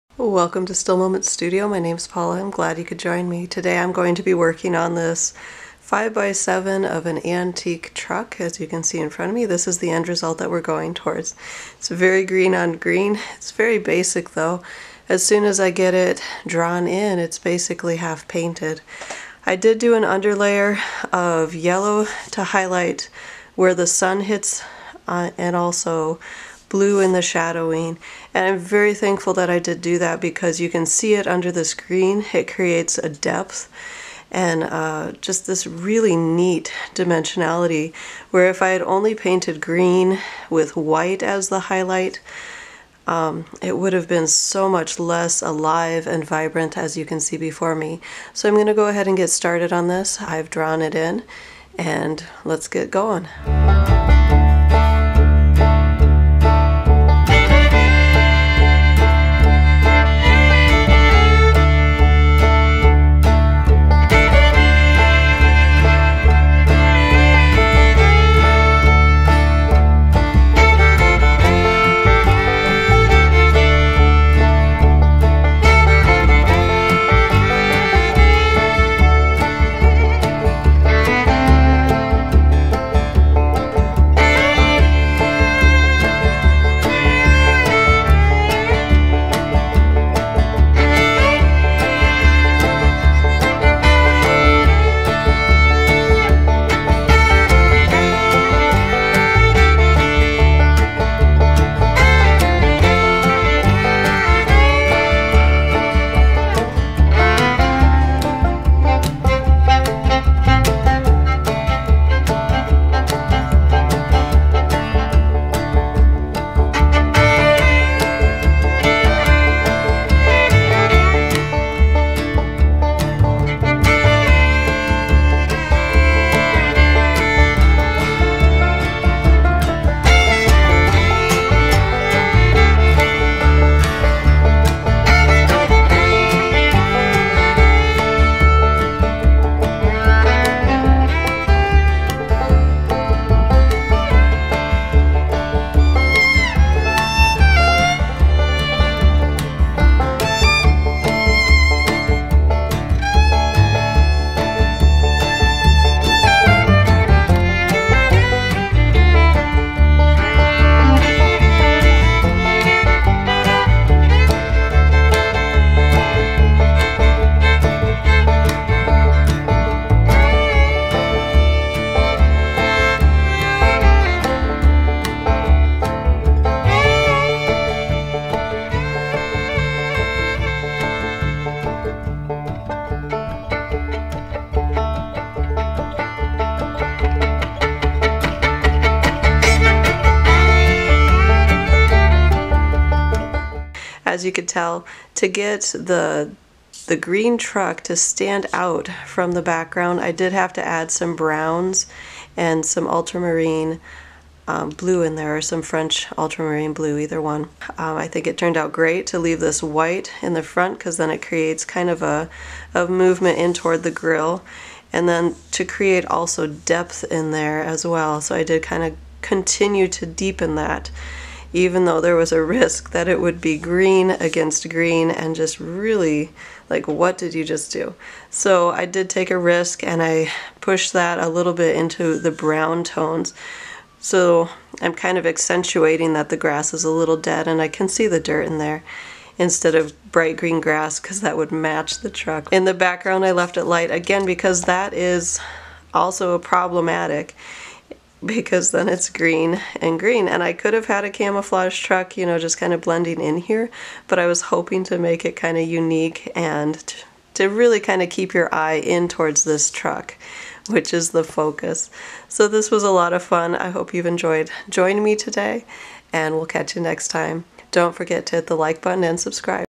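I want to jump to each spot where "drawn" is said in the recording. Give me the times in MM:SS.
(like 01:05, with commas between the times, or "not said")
00:16, 00:50.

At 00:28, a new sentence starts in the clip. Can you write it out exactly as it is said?
And I'm very thankful that I did do that because you can see it under the screen.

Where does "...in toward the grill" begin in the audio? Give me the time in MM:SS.
03:33.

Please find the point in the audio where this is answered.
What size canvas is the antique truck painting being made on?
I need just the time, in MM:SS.
00:05.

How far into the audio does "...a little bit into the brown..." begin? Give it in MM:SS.
03:51.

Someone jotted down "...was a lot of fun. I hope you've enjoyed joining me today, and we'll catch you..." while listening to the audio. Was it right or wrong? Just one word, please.
right.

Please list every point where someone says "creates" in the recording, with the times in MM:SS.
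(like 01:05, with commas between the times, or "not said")
00:32, 03:31, 03:35.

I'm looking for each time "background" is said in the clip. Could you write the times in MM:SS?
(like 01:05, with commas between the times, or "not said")
03:19, 04:02.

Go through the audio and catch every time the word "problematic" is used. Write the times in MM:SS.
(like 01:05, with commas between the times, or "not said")
04:06.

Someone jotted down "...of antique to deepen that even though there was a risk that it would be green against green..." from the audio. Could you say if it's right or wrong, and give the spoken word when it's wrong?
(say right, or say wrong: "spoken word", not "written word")
wrong: "continue", not "antique".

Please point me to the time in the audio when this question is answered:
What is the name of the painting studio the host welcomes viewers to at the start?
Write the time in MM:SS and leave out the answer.
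00:00.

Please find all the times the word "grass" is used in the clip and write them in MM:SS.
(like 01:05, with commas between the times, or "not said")
03:56, 04:00.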